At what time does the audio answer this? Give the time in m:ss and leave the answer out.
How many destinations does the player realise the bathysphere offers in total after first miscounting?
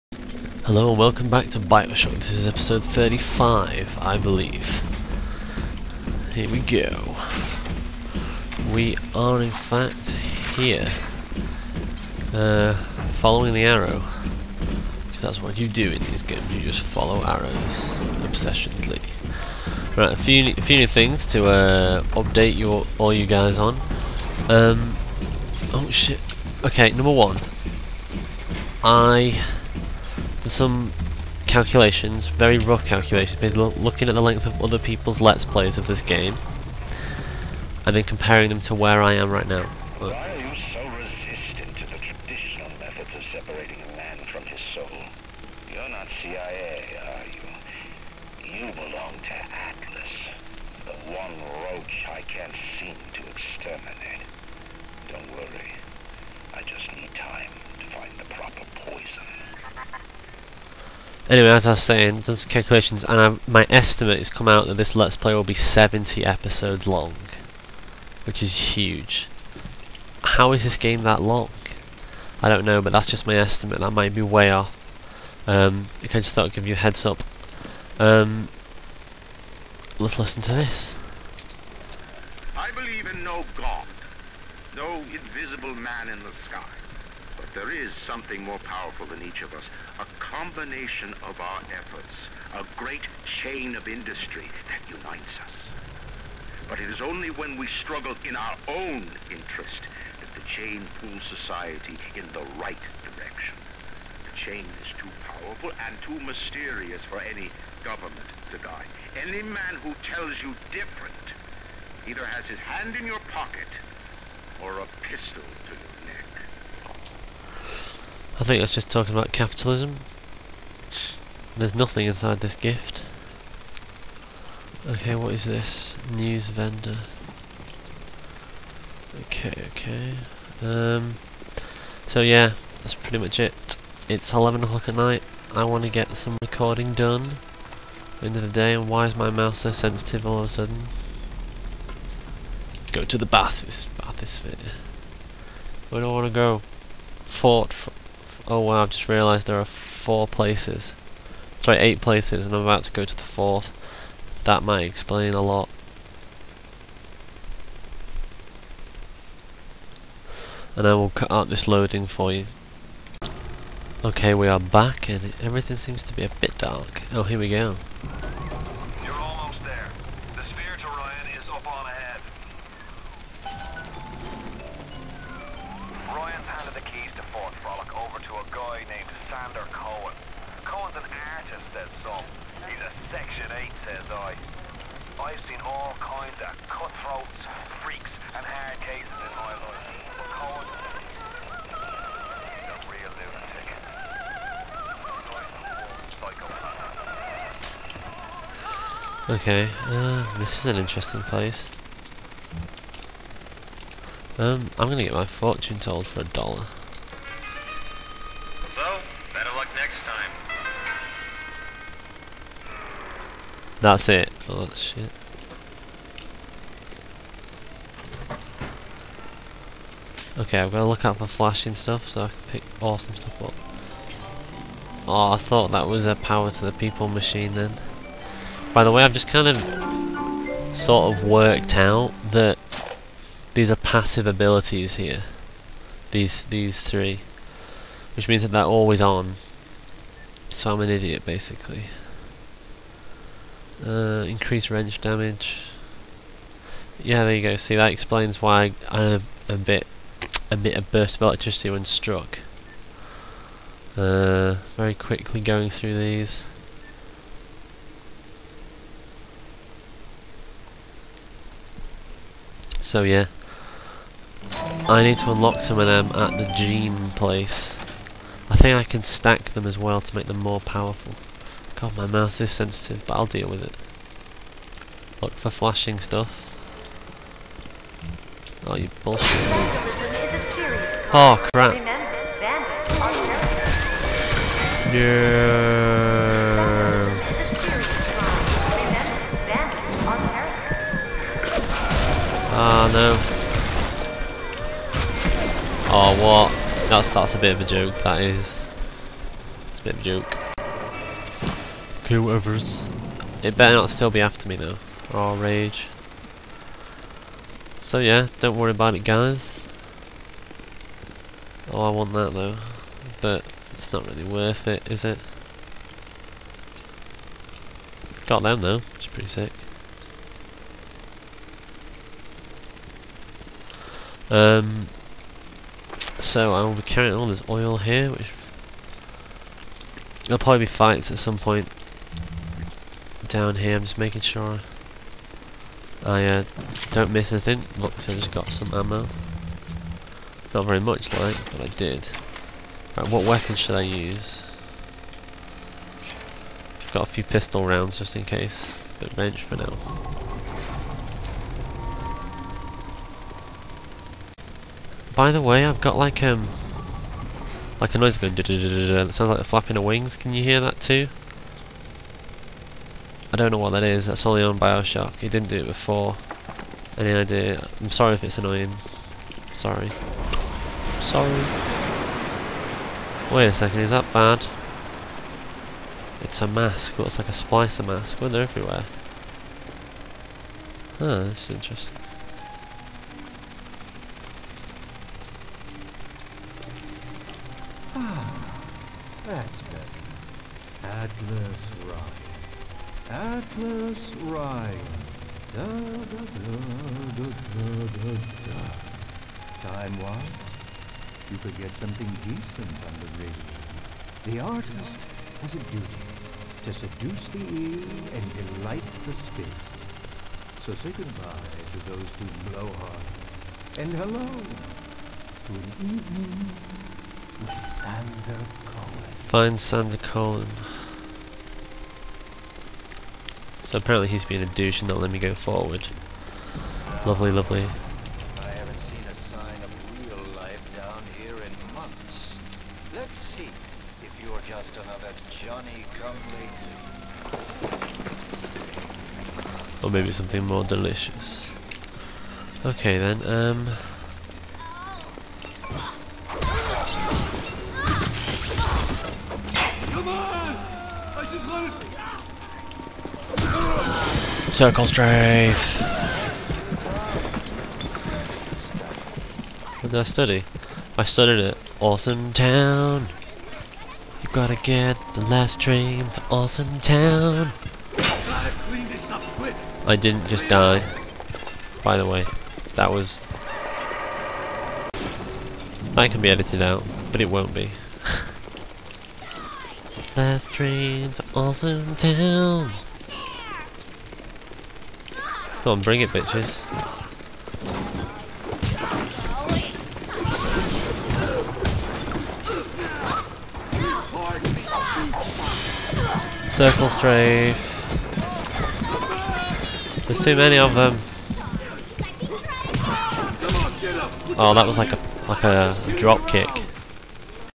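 2:31.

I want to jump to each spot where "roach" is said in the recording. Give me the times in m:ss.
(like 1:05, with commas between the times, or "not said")
0:51.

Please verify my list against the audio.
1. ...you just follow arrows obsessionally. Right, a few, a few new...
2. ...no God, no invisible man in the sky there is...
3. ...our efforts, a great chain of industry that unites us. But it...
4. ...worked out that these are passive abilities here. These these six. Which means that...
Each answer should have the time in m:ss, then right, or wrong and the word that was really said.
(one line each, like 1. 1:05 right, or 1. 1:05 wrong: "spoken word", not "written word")
1. 0:16 right
2. 1:23 right
3. 1:31 right
4. 3:51 wrong: "three", not "six".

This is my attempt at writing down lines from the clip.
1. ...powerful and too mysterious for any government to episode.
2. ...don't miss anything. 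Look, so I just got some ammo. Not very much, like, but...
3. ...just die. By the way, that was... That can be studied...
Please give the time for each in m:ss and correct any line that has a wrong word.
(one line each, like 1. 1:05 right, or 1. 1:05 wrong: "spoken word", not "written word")
1. 1:45 wrong: "guide", not "episode"
2. 5:36 right
3. 7:50 wrong: "edited", not "studied".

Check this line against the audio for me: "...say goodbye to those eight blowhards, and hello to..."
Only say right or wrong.
wrong.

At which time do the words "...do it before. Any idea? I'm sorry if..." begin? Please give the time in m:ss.
6:05.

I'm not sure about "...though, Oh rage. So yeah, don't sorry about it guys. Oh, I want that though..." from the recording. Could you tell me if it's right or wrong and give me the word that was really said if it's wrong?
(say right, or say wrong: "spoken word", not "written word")
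wrong: "worry", not "sorry".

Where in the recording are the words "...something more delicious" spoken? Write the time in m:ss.
7:20.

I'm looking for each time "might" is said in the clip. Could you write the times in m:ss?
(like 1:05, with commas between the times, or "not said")
1:13, 2:34.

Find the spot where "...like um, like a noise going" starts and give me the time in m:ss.
5:55.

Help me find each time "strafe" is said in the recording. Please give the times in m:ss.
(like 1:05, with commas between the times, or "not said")
7:34, 8:16.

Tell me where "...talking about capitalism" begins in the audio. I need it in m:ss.
1:58.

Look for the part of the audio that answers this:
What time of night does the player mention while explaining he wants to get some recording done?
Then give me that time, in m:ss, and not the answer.
2:14.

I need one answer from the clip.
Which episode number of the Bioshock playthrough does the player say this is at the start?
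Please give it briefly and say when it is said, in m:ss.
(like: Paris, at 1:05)
35, at 0:02.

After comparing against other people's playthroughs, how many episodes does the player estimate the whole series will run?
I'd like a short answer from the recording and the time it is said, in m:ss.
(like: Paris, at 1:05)
70, at 1:05.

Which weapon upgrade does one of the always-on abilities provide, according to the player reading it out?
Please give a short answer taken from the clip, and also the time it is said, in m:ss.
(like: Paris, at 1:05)
increased wrench damage, at 4:04.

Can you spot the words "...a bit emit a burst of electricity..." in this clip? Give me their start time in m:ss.
4:09.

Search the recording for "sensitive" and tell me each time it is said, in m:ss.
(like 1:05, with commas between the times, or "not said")
2:19, 4:32.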